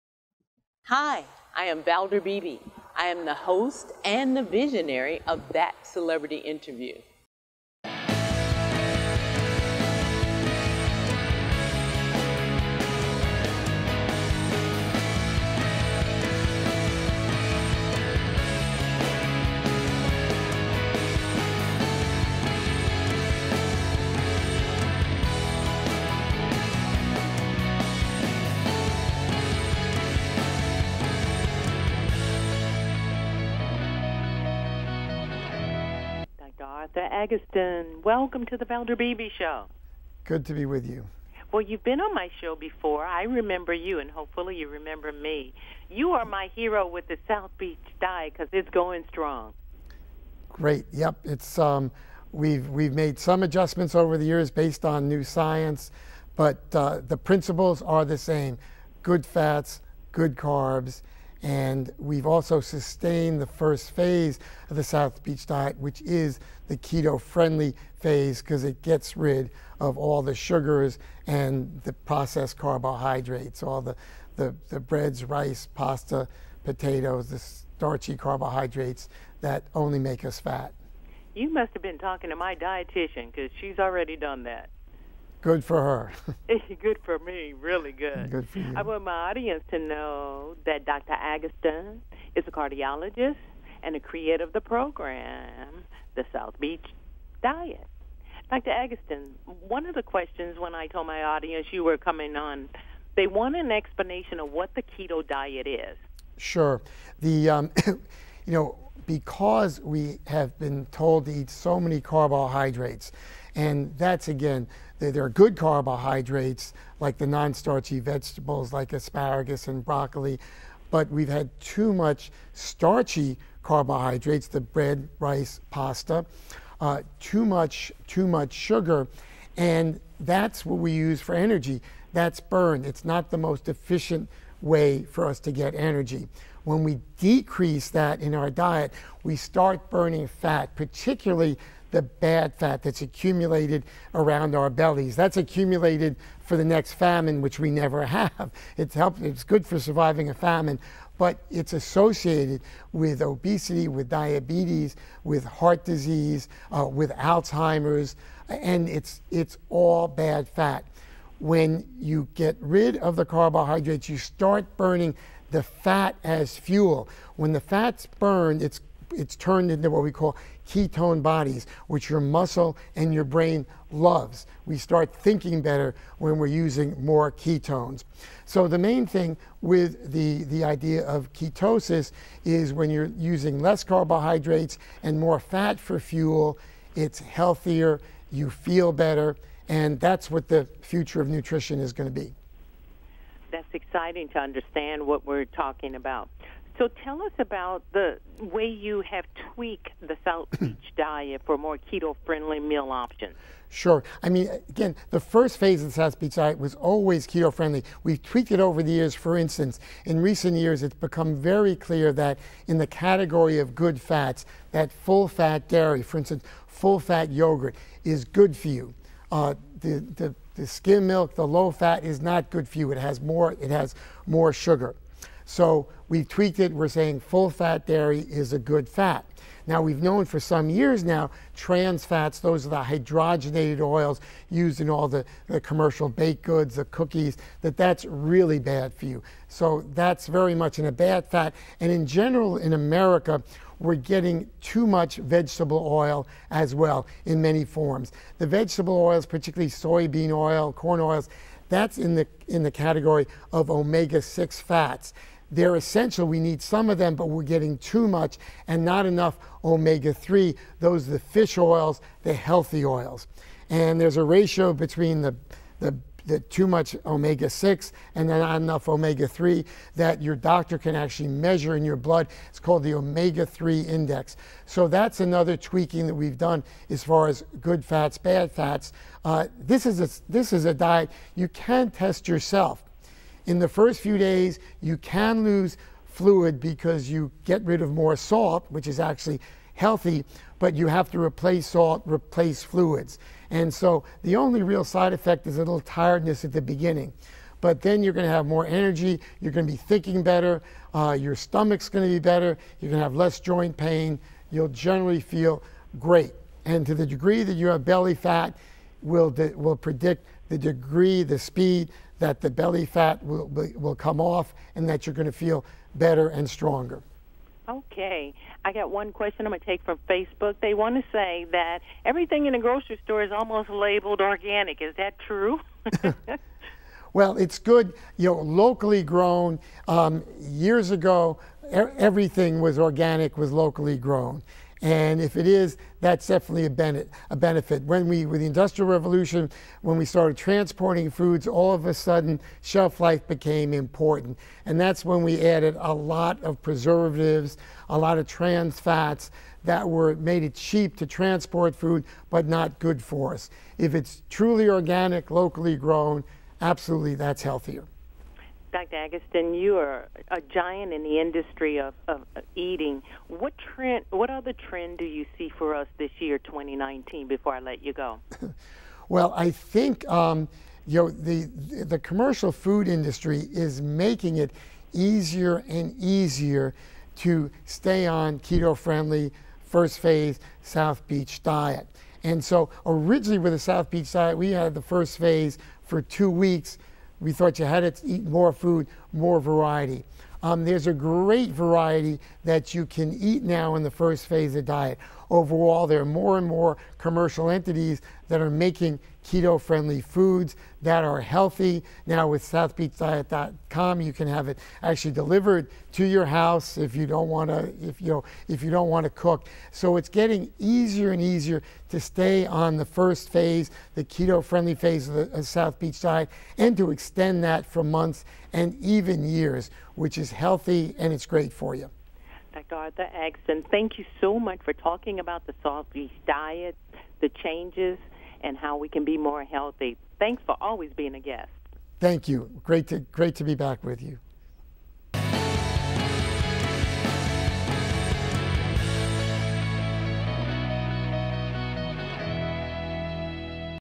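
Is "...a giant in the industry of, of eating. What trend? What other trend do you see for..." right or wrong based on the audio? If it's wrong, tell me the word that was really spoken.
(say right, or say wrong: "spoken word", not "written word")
right.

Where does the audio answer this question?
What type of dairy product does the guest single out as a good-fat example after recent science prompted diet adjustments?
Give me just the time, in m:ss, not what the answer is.
3:36.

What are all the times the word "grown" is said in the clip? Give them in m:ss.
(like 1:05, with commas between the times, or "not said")
5:29, 5:33, 5:55.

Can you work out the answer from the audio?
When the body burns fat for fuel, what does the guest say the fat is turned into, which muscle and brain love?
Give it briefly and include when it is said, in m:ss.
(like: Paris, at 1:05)
ketone bodies, at 2:50.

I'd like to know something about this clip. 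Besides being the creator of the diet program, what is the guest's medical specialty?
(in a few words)
cardiologist.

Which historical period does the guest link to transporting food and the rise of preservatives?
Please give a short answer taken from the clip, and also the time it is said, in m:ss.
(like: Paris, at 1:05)
Industrial Revolution, at 5:38.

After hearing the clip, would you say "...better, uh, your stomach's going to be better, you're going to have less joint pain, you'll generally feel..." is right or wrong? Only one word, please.
right.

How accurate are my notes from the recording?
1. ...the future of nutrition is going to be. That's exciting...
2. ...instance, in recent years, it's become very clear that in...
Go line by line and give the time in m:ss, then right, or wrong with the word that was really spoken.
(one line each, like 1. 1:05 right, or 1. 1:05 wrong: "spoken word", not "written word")
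1. 3:10 right
2. 3:29 right.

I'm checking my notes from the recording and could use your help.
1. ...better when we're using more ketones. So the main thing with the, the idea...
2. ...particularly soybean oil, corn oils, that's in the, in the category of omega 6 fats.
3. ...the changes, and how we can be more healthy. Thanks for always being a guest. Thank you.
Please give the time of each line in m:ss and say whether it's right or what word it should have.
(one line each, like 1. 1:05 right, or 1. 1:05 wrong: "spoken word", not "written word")
1. 2:55 right
2. 4:09 right
3. 7:07 right.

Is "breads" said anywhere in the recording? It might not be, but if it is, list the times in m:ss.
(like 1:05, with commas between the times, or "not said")
1:14, 2:04.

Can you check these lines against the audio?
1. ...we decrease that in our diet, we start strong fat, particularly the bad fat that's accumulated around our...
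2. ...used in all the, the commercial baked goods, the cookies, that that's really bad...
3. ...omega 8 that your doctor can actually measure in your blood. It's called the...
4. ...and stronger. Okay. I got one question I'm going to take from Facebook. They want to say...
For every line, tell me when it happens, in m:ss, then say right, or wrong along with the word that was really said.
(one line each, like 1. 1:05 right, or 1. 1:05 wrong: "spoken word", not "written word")
1. 2:16 wrong: "burning", not "strong"
2. 3:54 right
3. 4:28 wrong: "3", not "8"
4. 5:16 right.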